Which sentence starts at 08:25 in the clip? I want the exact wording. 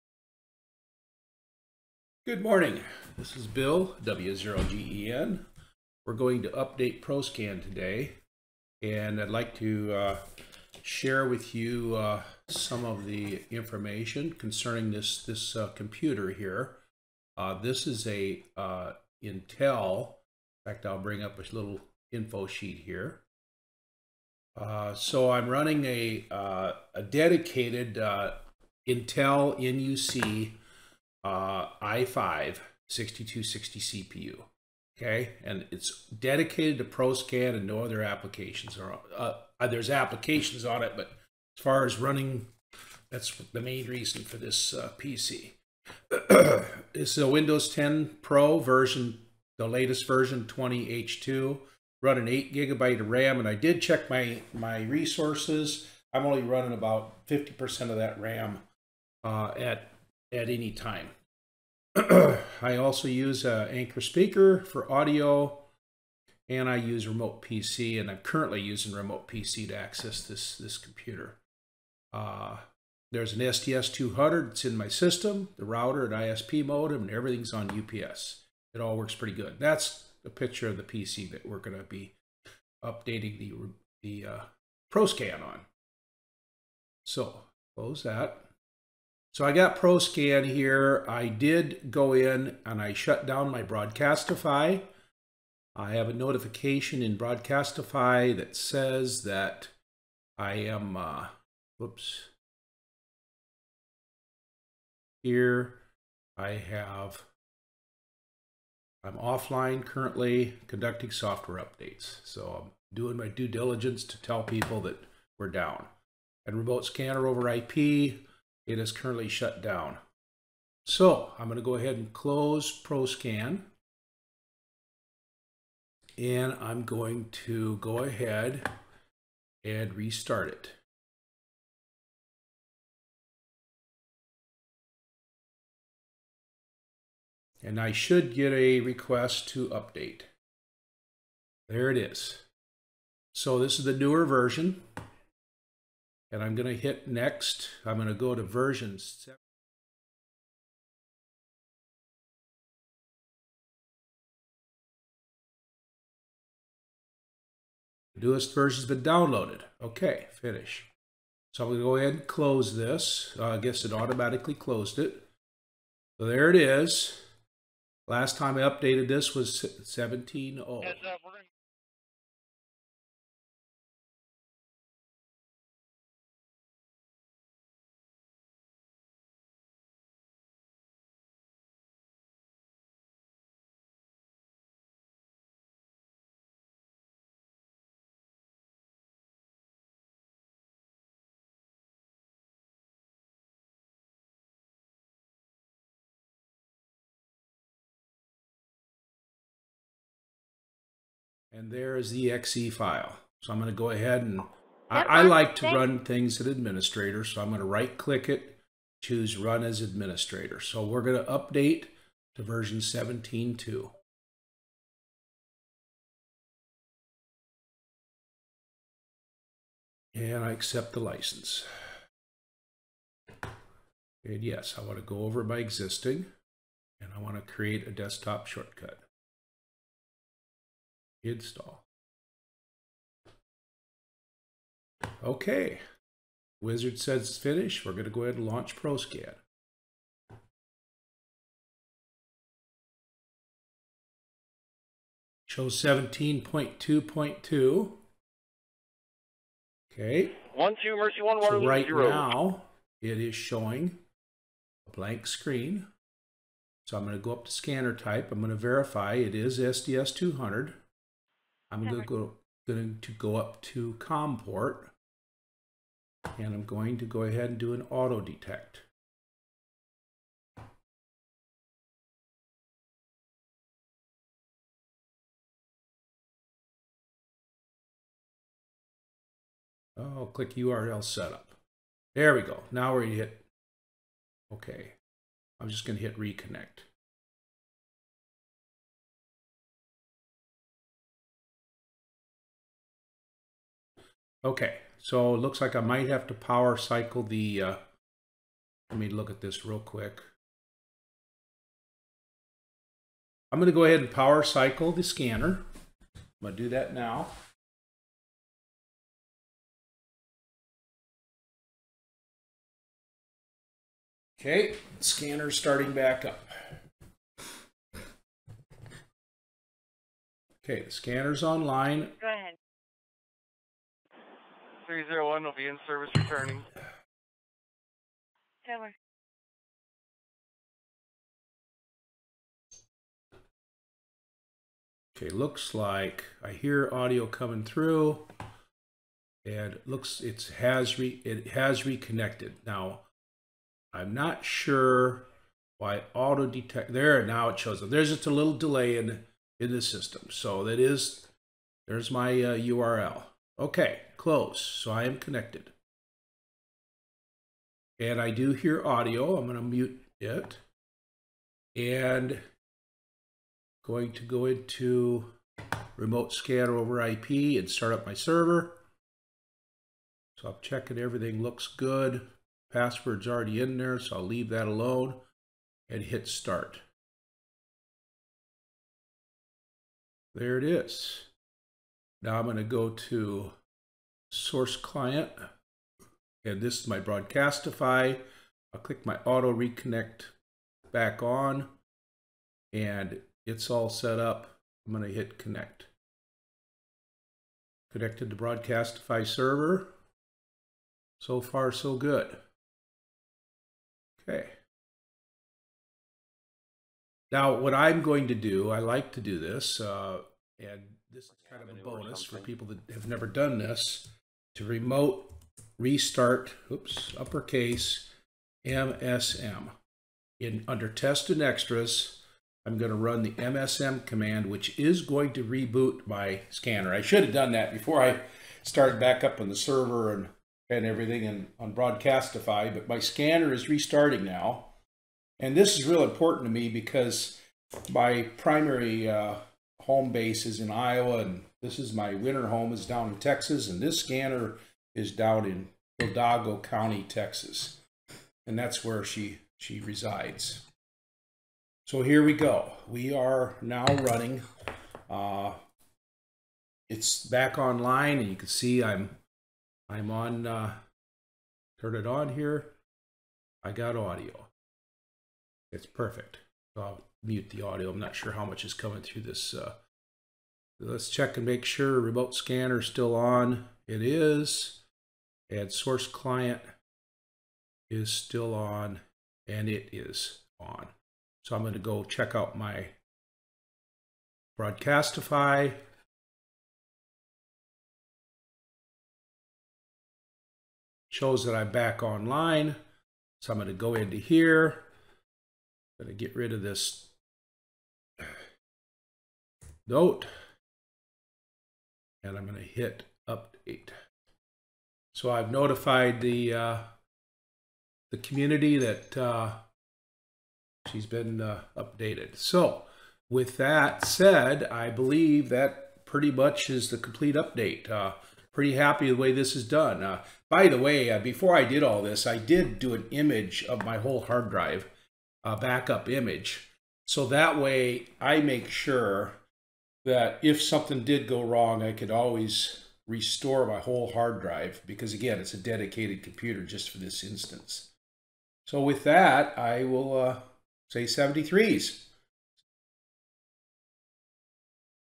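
So I've notified the uh, the community that uh, she's been uh, updated.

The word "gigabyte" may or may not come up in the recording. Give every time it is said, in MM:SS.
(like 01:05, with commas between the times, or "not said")
00:52.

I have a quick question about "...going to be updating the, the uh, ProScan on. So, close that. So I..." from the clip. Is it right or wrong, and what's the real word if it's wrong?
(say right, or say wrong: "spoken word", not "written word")
right.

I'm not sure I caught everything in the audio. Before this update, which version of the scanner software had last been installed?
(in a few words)
17.0.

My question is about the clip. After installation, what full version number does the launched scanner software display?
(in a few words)
17.2.2.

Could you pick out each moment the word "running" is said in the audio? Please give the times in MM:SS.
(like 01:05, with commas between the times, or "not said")
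00:25, 00:41, 00:56, 07:33.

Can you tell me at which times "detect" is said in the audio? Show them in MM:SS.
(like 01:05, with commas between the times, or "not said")
04:28, 05:46.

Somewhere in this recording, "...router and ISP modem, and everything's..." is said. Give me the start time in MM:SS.
01:15.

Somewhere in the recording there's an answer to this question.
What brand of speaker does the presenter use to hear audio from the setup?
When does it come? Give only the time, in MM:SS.
01:03.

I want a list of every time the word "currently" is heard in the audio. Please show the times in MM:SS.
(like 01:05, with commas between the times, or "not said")
01:08, 01:49, 01:58.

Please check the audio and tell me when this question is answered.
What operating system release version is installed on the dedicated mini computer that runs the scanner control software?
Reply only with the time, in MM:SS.
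00:50.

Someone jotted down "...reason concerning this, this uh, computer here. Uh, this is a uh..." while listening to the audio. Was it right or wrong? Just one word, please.
wrong.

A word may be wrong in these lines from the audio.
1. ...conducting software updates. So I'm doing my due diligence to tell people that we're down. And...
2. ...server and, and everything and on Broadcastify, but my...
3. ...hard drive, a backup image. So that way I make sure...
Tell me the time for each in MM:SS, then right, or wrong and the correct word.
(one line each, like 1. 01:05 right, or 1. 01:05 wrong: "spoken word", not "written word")
1. 01:50 right
2. 07:09 right
3. 08:44 right.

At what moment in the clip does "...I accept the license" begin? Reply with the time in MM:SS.
03:40.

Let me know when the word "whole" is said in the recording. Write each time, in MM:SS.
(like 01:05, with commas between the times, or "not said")
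08:43, 08:53.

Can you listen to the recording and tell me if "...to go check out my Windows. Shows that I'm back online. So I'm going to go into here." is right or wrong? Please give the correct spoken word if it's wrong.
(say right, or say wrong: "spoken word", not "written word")
wrong: "Broadcastify", not "Windows".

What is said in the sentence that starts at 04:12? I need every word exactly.
now, it is showing a blank screen.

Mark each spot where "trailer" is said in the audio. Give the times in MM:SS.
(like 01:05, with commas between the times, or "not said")
not said.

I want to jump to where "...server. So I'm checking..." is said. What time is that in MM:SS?
06:08.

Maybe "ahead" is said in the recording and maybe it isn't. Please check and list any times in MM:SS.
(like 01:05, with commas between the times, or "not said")
02:01, 02:07, 02:41, 03:23, 03:58, 04:27, 05:03, 05:22.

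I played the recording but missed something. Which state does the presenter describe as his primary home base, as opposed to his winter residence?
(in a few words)
Iowa.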